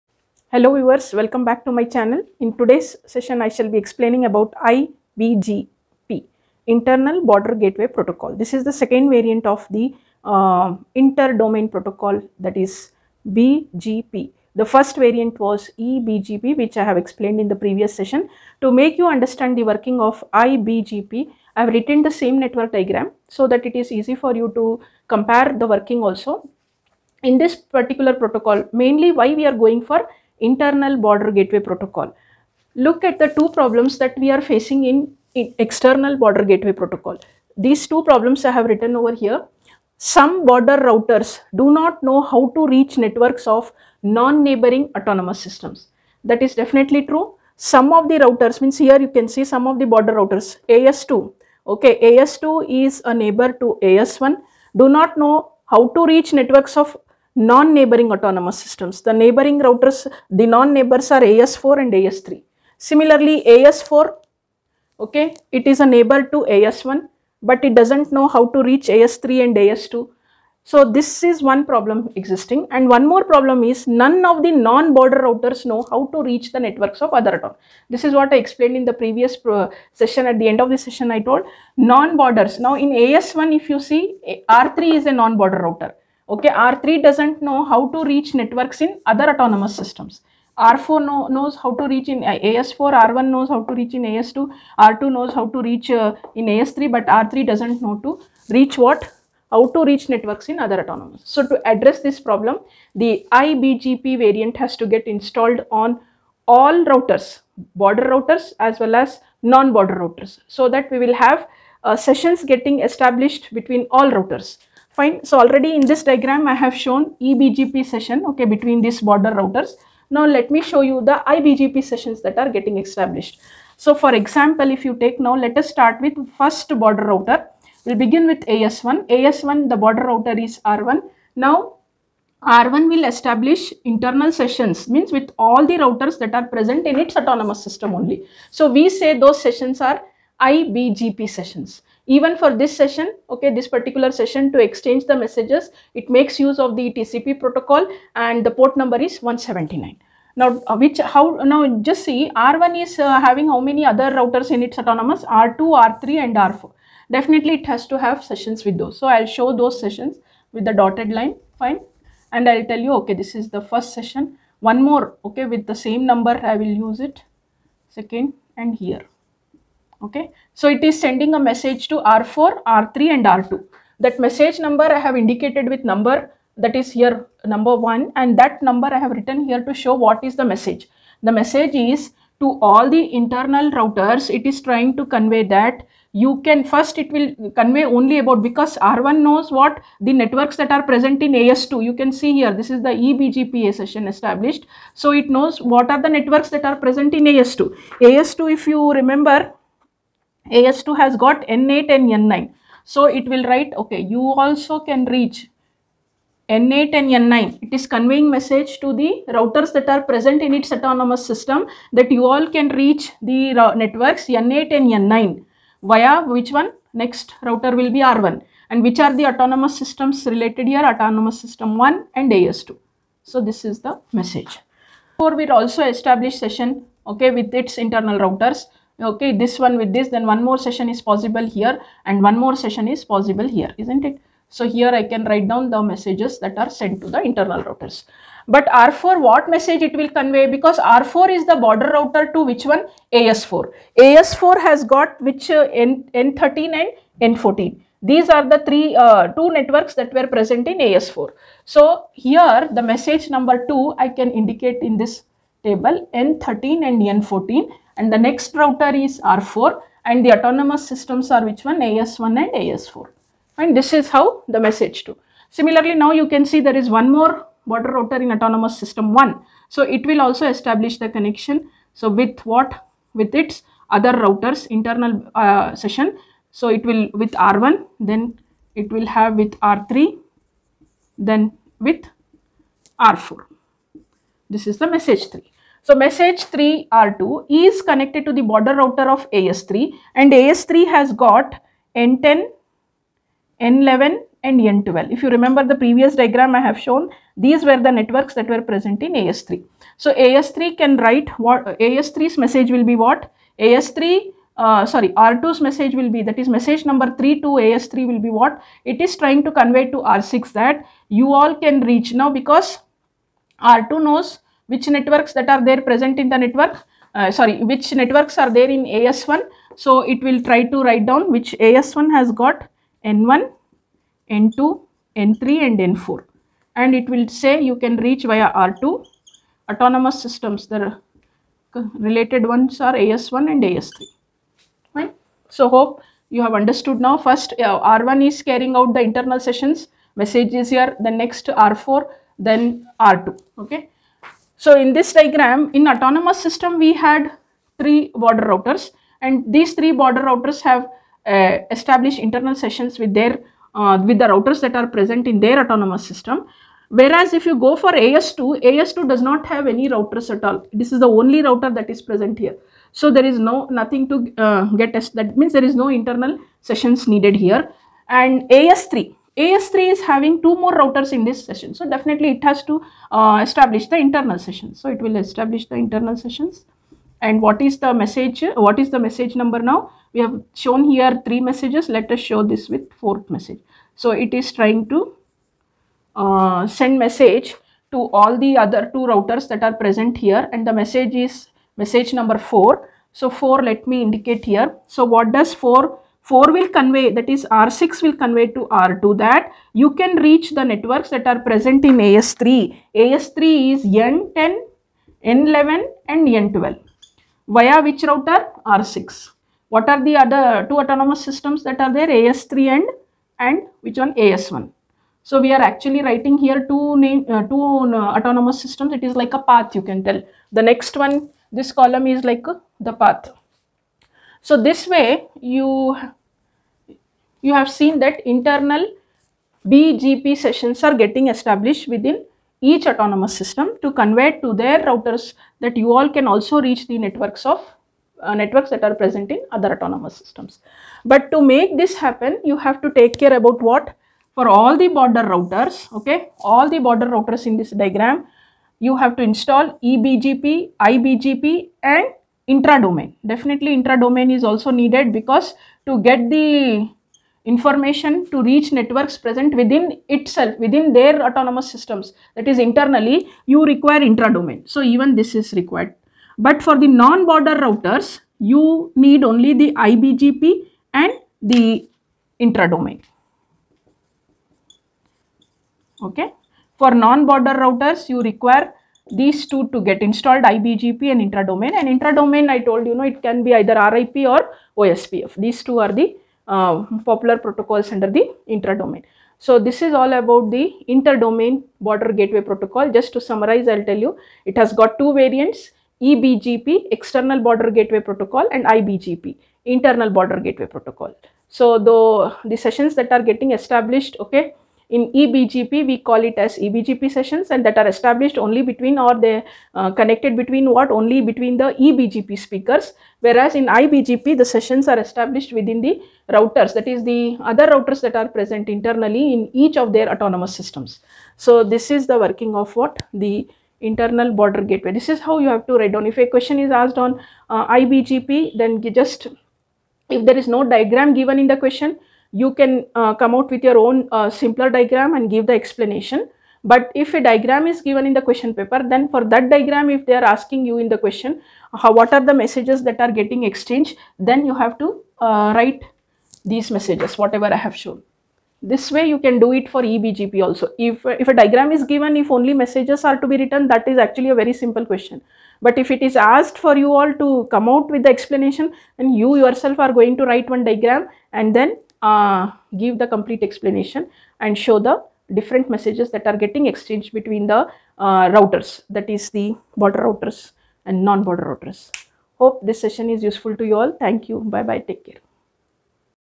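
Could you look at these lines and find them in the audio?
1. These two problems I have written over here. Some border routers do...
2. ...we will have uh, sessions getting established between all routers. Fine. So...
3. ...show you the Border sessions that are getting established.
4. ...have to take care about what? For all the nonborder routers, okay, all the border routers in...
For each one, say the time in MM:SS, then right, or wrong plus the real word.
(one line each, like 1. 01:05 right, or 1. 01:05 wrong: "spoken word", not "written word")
1. 00:37 right
2. 01:50 right
3. 02:00 wrong: "IBGP", not "Border"
4. 07:22 wrong: "border", not "nonborder".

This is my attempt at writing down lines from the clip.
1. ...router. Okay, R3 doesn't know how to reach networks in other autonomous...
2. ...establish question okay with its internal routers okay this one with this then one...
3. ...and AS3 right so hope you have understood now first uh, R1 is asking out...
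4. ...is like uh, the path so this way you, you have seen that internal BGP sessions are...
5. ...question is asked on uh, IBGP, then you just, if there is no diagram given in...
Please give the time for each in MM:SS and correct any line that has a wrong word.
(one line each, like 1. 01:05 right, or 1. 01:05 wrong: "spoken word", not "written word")
1. 01:25 right
2. 03:45 wrong: "session", not "question"
3. 05:33 wrong: "carrying", not "asking"
4. 07:02 right
5. 08:46 right.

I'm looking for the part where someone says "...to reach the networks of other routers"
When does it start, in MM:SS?
01:16.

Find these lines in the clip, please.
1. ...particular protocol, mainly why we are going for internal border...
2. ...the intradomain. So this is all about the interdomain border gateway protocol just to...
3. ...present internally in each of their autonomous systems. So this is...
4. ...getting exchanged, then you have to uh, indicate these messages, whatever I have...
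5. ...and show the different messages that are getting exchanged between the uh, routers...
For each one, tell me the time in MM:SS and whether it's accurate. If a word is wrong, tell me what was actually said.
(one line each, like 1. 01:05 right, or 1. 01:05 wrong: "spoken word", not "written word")
1. 00:27 right
2. 08:08 right
3. 08:38 right
4. 09:03 wrong: "write", not "indicate"
5. 09:24 right.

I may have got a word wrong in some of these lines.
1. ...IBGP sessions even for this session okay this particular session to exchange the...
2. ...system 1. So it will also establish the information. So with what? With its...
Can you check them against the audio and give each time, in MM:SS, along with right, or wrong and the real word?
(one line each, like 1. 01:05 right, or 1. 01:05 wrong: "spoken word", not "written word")
1. 02:20 right
2. 04:28 wrong: "connection", not "information".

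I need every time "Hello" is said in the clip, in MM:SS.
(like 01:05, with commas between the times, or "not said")
00:00.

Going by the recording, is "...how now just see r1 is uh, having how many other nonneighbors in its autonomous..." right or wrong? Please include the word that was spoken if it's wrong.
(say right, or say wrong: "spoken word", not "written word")
wrong: "routers", not "nonneighbors".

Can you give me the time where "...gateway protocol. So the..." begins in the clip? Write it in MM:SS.
08:20.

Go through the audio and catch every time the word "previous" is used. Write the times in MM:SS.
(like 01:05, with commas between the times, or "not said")
00:17, 01:18, 04:55.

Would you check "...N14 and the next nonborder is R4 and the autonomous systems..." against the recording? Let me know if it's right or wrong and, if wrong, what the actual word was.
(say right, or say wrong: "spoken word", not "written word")
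wrong: "router", not "nonborder".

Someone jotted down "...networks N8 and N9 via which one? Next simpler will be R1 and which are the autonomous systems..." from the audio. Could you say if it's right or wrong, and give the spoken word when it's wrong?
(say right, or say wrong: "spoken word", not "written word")
wrong: "router", not "simpler".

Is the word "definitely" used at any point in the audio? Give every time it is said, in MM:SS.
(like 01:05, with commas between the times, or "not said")
00:46, 02:37, 06:11, 07:33.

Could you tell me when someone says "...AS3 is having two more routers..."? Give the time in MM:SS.
06:09.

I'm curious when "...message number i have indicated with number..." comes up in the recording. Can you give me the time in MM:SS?
02:54.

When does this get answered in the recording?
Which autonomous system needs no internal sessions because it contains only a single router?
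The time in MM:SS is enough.
05:58.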